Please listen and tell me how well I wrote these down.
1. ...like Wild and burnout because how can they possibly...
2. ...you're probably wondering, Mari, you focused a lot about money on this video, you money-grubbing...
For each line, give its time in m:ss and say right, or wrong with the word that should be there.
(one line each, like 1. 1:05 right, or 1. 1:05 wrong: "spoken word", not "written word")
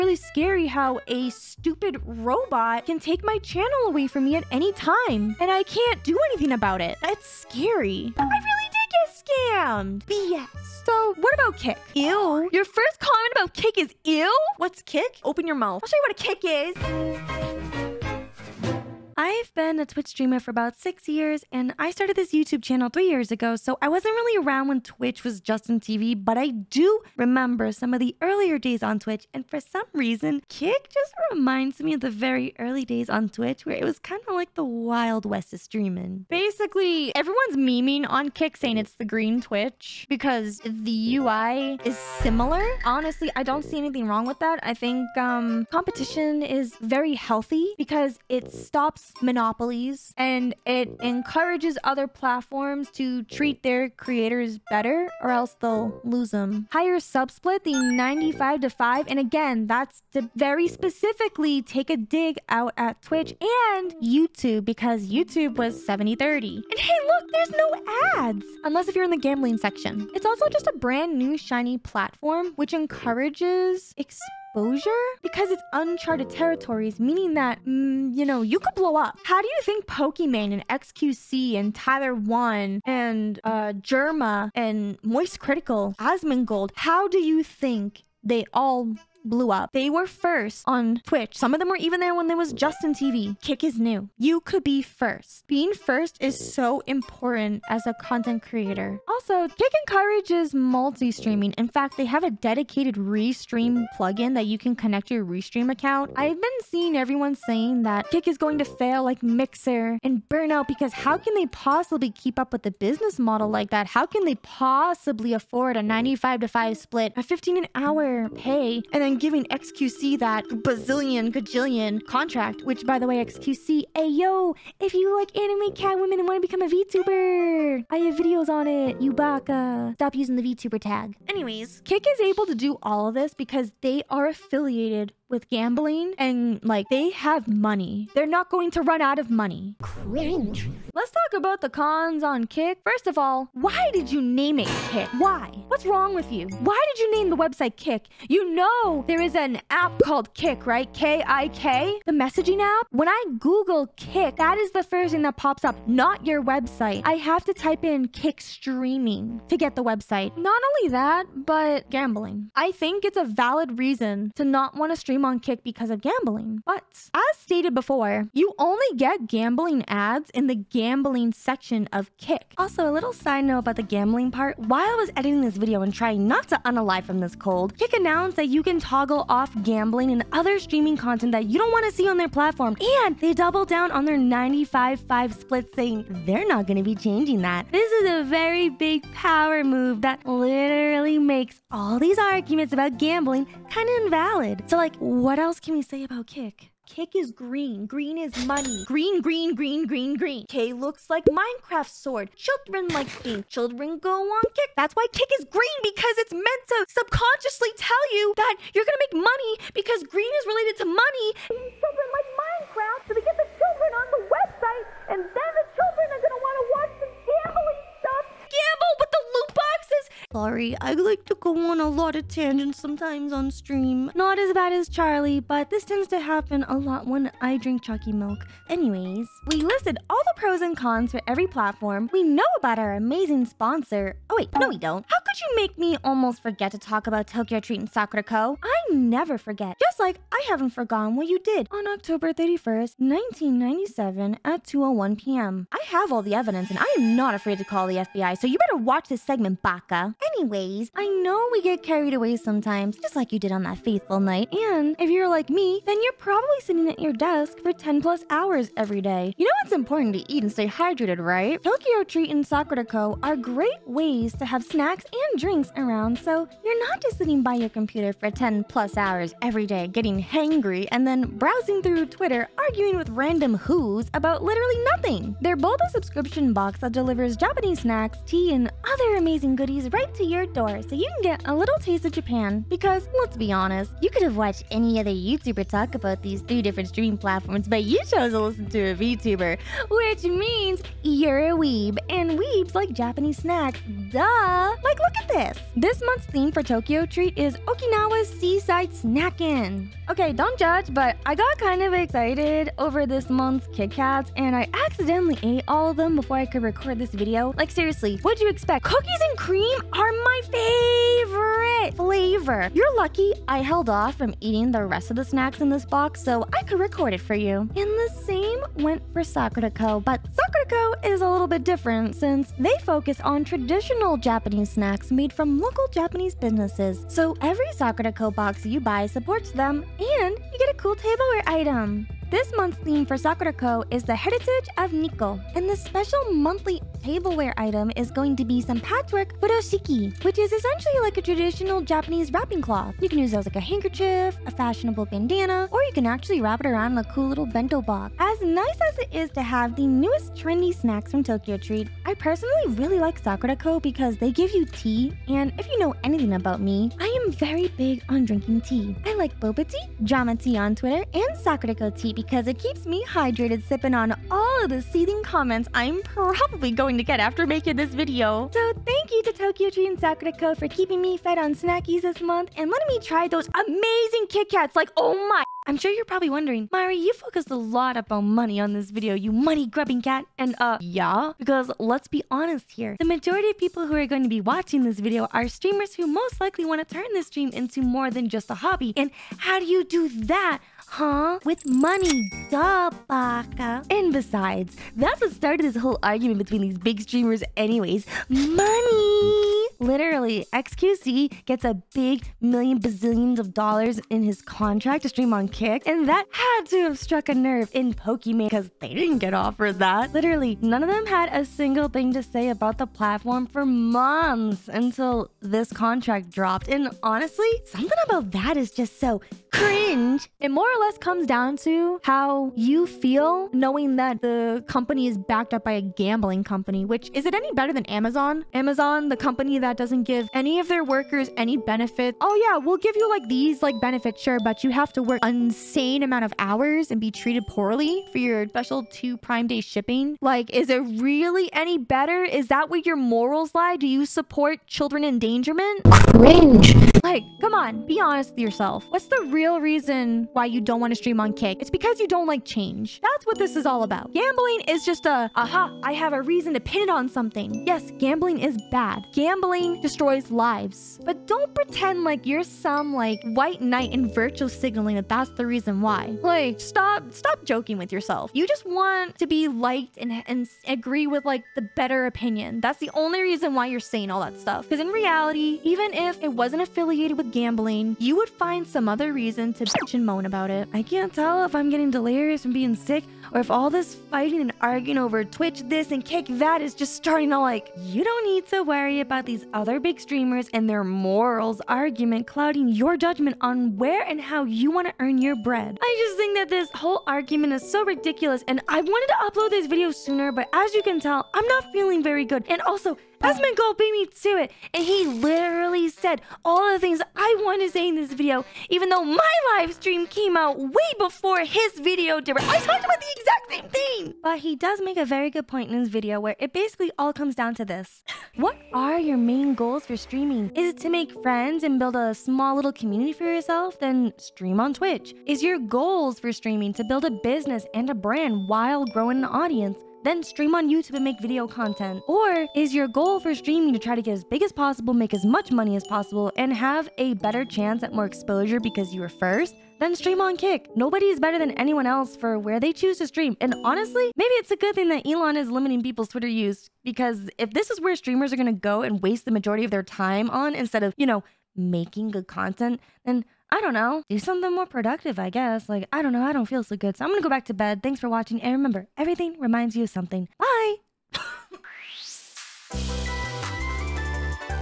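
1. 1:49 wrong: "Mixer", not "Wild"
2. 6:15 right.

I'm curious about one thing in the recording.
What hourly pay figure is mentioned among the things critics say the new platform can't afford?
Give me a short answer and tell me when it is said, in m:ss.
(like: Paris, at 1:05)
15 an hour, at 1:57.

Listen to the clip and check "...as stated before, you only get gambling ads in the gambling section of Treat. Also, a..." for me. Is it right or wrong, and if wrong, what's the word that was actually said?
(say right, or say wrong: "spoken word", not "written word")
wrong: "Kick", not "Treat".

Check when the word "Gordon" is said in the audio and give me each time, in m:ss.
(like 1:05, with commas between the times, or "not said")
not said.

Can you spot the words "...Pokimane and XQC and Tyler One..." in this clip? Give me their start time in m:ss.
1:19.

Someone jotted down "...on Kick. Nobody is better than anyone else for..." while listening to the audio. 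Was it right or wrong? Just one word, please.
right.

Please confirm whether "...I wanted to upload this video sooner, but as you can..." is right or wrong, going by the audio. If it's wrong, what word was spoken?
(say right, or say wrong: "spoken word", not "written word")
right.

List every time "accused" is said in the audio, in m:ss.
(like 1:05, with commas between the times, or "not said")
not said.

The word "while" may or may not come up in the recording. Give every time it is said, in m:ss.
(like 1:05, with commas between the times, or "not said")
2:54, 8:48.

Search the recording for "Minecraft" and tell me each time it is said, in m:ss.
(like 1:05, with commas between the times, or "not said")
3:21, 3:32.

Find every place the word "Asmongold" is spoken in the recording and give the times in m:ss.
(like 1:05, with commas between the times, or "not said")
1:25, 8:23.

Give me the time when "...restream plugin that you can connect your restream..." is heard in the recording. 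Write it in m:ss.
1:42.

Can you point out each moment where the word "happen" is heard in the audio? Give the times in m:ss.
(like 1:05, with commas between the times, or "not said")
3:46.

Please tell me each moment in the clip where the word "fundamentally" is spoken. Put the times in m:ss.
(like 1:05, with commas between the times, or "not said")
not said.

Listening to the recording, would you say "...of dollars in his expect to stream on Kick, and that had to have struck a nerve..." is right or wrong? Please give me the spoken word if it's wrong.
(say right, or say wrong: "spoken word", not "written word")
wrong: "contract", not "expect".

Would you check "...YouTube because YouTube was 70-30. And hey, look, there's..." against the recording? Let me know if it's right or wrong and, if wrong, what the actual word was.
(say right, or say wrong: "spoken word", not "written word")
right.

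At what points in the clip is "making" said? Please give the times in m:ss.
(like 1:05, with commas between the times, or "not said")
6:07, 9:11.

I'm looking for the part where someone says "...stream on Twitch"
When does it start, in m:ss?
8:44.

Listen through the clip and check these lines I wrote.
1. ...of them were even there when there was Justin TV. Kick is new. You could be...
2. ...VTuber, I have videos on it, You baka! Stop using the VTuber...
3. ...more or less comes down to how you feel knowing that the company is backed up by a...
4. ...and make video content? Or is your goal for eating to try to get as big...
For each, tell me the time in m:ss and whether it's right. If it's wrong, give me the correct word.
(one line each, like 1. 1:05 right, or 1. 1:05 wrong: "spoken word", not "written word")
1. 1:31 right
2. 2:06 right
3. 7:00 right
4. 8:50 wrong: "streaming", not "eating".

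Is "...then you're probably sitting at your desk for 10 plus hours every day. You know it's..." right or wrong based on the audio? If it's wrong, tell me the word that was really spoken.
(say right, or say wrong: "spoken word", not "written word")
right.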